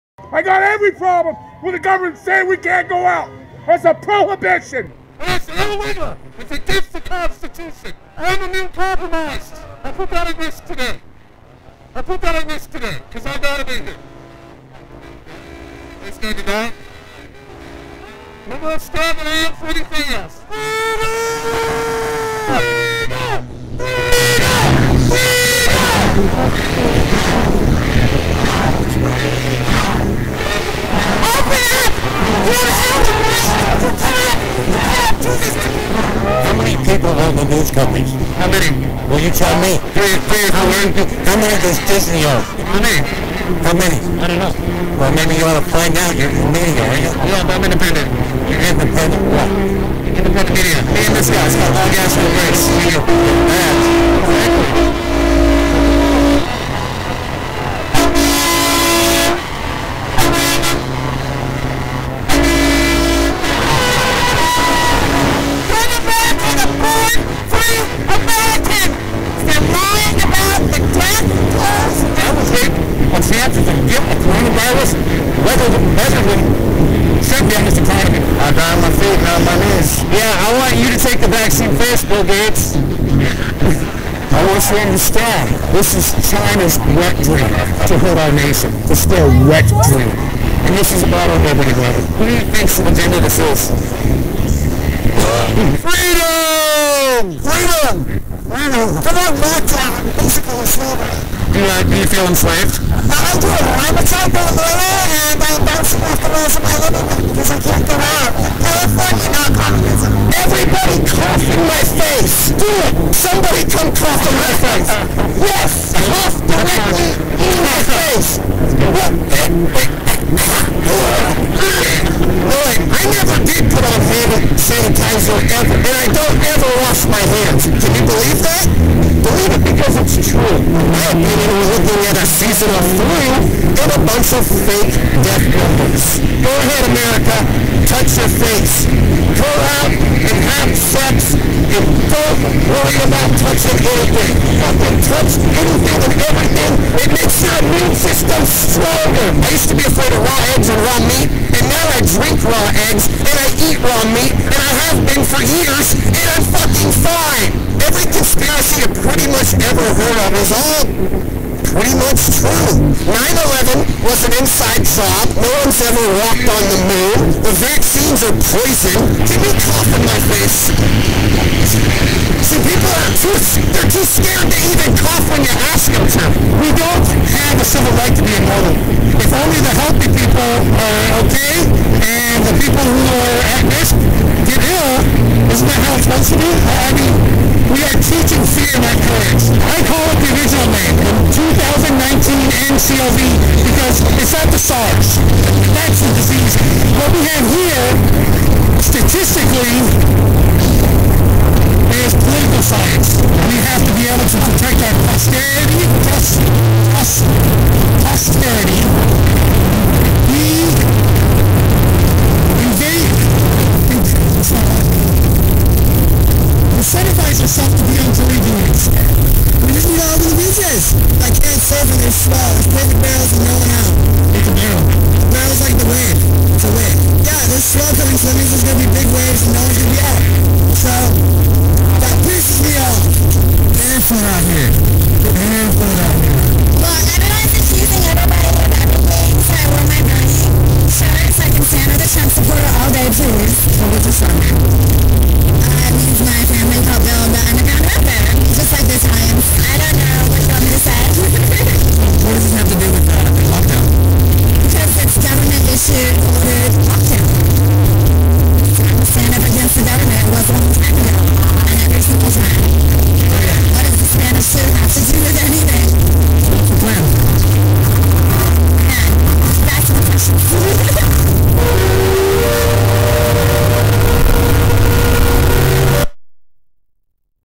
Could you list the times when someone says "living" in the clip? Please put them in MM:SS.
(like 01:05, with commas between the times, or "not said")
01:46.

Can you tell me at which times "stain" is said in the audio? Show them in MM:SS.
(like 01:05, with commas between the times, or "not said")
not said.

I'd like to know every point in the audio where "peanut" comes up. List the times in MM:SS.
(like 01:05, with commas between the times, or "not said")
not said.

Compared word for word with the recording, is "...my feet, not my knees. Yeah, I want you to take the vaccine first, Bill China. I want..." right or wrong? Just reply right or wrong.
wrong.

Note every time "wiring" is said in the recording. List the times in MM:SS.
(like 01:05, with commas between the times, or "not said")
not said.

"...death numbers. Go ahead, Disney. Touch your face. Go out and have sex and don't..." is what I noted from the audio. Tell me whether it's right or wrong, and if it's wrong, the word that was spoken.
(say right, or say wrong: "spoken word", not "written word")
wrong: "America", not "Disney".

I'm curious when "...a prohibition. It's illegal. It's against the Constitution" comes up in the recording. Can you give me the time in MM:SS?
00:03.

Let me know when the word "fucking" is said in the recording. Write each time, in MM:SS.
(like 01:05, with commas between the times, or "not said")
02:24, 02:36, 04:01.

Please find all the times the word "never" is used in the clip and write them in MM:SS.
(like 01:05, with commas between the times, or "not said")
02:03.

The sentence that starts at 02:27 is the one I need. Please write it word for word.
It makes your immune system stronger.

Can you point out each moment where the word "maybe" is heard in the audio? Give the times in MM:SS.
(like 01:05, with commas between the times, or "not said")
00:45.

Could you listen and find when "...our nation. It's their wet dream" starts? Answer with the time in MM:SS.
01:28.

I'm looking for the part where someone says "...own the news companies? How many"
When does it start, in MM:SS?
00:37.